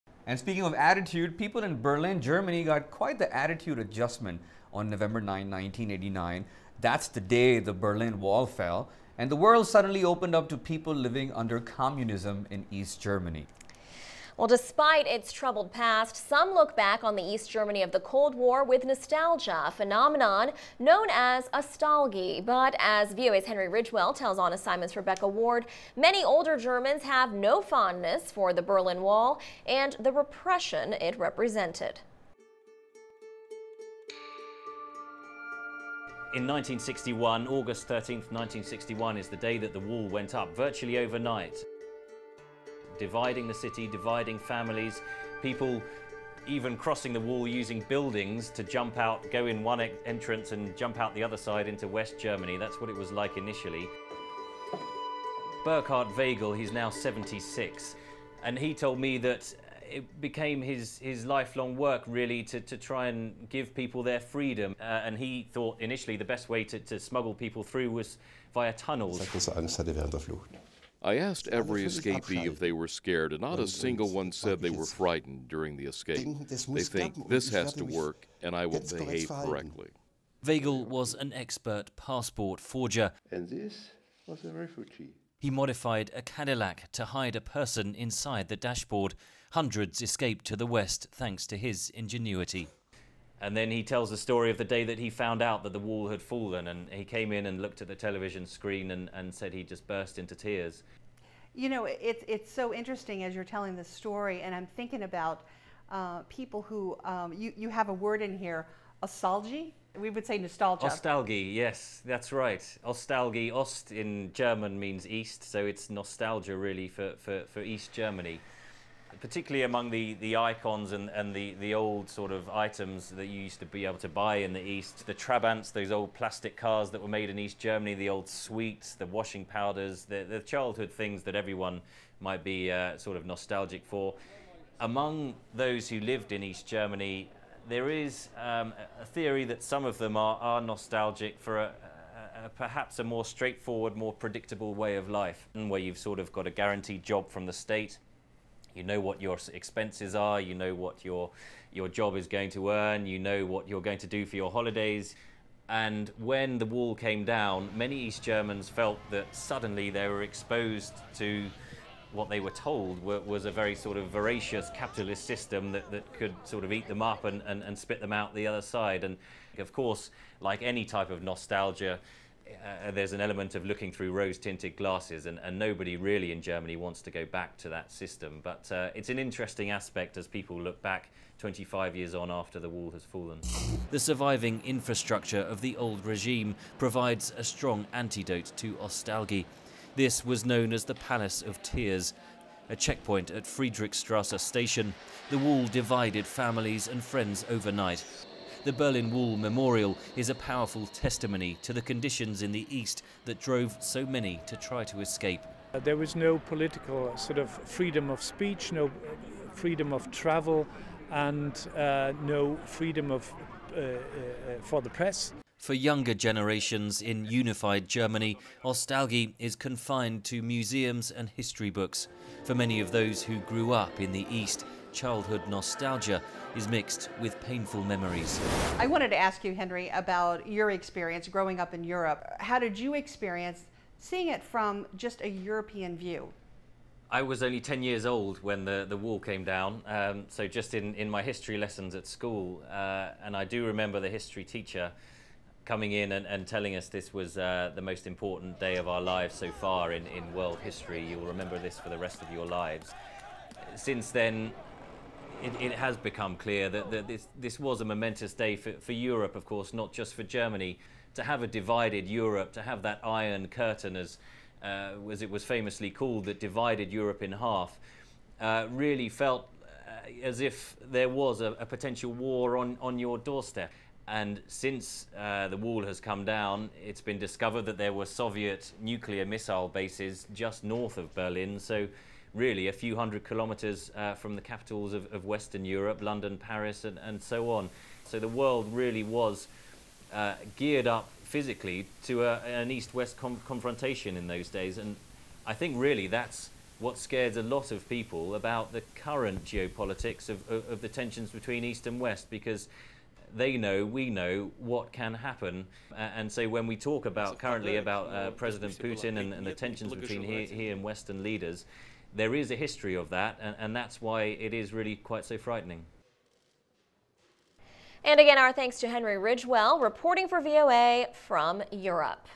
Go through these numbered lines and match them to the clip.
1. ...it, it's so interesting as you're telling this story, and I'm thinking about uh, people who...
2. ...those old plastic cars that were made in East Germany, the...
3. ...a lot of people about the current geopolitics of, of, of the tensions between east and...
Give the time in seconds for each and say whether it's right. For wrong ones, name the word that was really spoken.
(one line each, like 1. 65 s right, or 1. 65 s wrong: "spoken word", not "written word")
1. 101 s right
2. 125 s right
3. 297 s right.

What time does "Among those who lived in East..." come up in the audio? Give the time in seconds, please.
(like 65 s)
134 s.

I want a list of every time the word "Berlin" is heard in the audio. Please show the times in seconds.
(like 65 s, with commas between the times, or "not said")
1 s, 7 s, 28 s, 198 s, 281 s.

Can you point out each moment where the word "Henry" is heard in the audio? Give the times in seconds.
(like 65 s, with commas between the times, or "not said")
23 s, 229 s, 318 s.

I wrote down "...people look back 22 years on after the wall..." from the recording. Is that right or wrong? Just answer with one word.
wrong.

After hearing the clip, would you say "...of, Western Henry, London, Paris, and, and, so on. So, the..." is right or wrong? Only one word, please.
wrong.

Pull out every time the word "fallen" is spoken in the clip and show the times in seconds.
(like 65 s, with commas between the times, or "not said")
96 s, 183 s.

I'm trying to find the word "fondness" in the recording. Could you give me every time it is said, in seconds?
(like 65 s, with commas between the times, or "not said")
27 s.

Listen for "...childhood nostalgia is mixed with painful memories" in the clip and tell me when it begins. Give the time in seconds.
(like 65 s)
224 s.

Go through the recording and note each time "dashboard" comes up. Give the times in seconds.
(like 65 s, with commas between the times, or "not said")
88 s.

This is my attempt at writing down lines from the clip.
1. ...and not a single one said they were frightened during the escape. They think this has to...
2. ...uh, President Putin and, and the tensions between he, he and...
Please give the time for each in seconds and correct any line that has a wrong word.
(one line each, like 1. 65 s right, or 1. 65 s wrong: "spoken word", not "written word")
1. 73 s right
2. 308 s right.